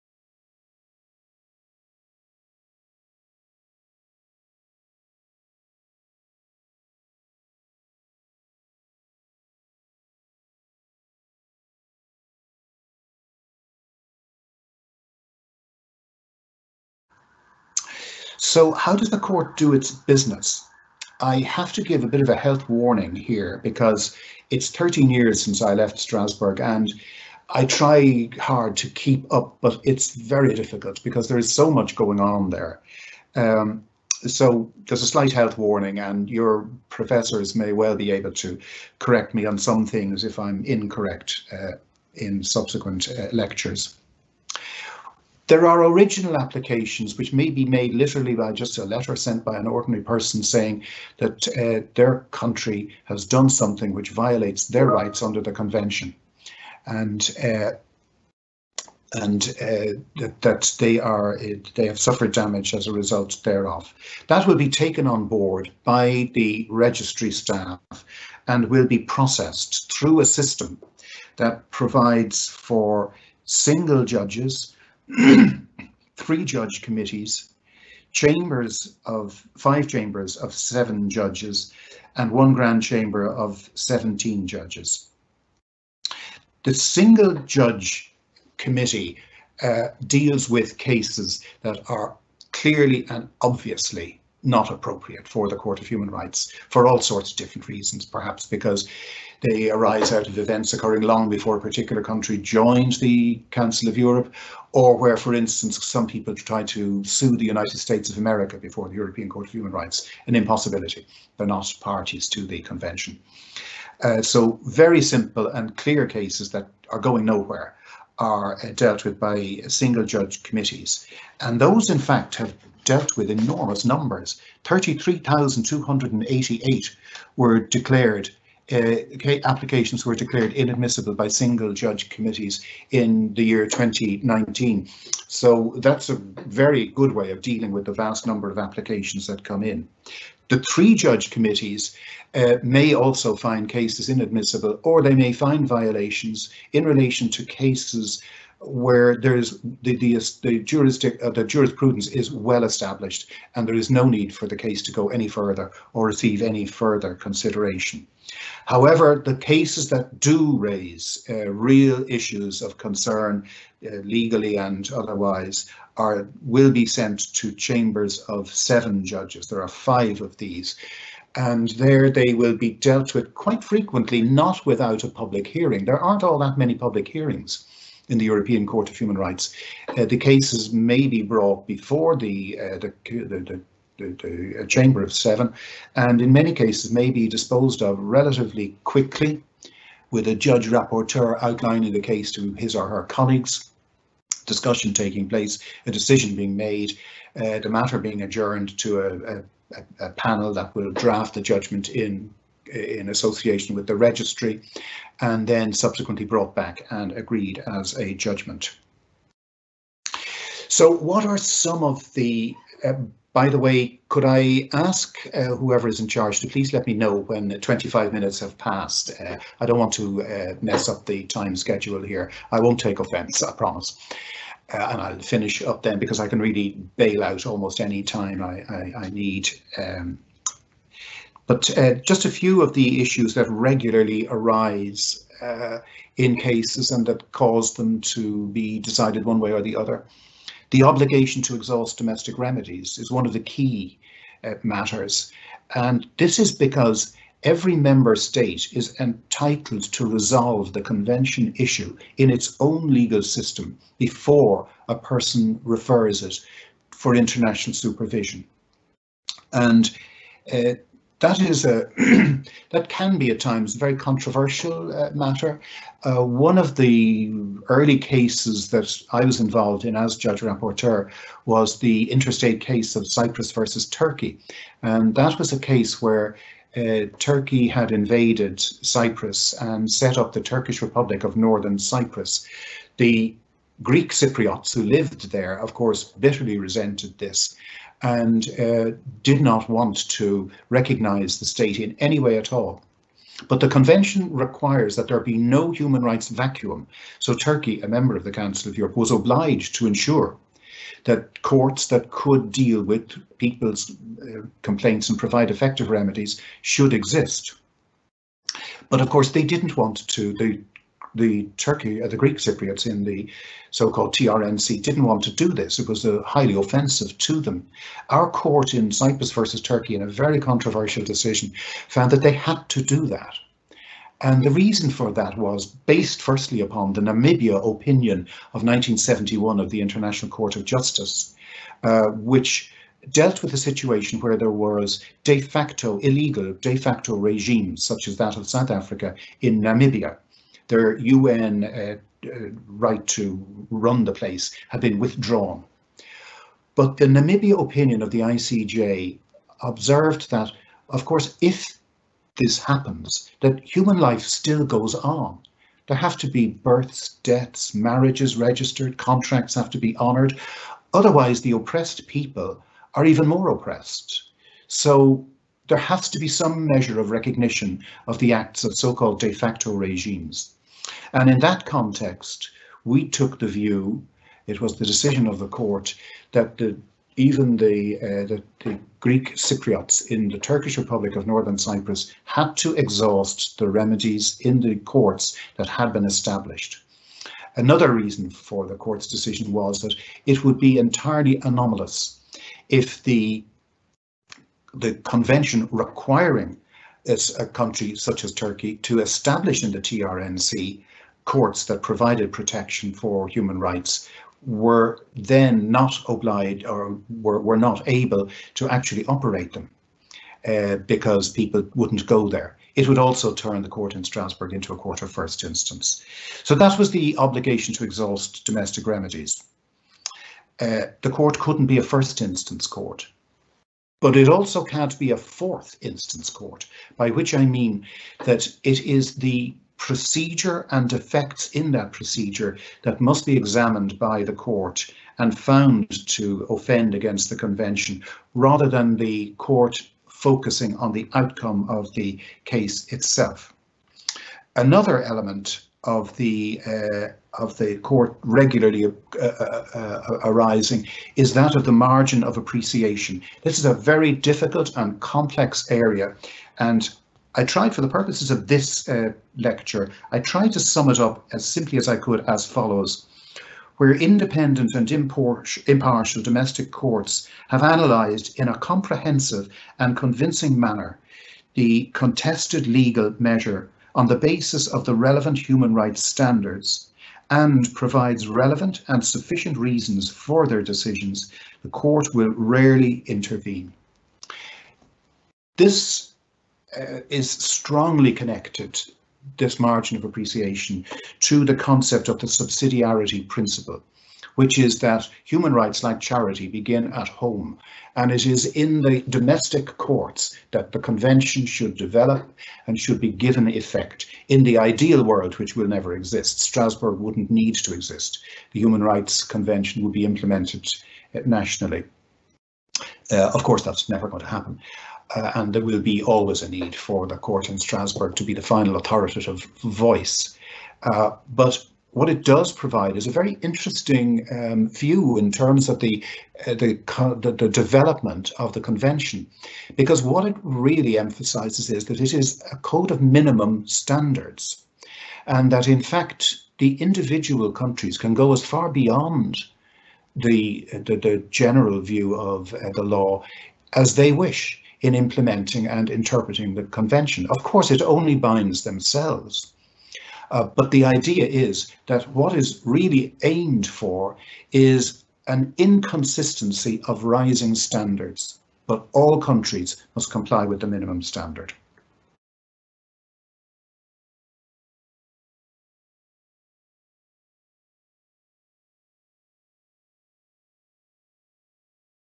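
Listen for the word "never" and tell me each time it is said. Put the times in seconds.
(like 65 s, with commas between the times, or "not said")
505 s, 513 s.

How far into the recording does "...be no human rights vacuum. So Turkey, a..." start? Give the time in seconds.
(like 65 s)
295 s.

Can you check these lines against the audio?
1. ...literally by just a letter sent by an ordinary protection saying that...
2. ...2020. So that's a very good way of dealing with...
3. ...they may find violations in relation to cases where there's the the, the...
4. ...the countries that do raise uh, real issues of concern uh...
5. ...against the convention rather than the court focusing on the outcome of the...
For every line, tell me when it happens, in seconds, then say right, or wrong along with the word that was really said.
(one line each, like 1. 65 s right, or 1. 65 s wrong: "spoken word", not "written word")
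1. 47 s wrong: "person", not "protection"
2. 133 s wrong: "2019", not "2020"
3. 145 s right
4. 159 s wrong: "cases", not "countries"
5. 436 s right.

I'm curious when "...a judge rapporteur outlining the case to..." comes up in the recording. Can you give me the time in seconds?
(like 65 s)
190 s.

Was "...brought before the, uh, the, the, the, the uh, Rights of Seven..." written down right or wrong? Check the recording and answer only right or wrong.
wrong.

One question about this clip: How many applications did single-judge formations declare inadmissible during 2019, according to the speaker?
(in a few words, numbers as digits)
33,288.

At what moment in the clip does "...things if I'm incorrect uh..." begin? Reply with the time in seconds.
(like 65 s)
39 s.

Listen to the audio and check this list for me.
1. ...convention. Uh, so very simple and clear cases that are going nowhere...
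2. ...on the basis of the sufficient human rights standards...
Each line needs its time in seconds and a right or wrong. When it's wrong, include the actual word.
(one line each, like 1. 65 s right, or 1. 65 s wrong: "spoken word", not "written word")
1. 112 s right
2. 473 s wrong: "relevant", not "sufficient".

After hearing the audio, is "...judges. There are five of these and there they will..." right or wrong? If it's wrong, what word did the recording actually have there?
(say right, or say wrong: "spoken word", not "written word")
right.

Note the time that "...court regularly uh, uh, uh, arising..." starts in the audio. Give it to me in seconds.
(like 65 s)
447 s.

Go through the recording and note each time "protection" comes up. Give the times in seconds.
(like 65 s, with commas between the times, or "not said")
402 s.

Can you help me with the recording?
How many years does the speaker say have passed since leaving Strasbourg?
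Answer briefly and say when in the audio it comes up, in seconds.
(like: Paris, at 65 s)
13, at 24 s.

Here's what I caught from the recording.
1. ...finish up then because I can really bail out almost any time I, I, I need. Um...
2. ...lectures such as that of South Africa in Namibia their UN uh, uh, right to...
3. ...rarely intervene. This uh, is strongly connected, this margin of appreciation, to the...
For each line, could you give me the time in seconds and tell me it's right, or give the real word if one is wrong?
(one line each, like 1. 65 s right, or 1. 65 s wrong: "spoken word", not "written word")
1. 225 s right
2. 337 s wrong: "regimes", not "lectures"
3. 482 s right.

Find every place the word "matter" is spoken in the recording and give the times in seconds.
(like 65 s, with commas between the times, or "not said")
197 s, 244 s, 265 s.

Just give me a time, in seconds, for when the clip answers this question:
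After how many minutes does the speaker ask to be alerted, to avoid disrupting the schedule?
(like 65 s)
217 s.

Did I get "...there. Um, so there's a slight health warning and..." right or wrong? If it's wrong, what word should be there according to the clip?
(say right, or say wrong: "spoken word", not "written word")
right.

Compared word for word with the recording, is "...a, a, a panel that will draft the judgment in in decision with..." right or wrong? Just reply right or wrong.
wrong.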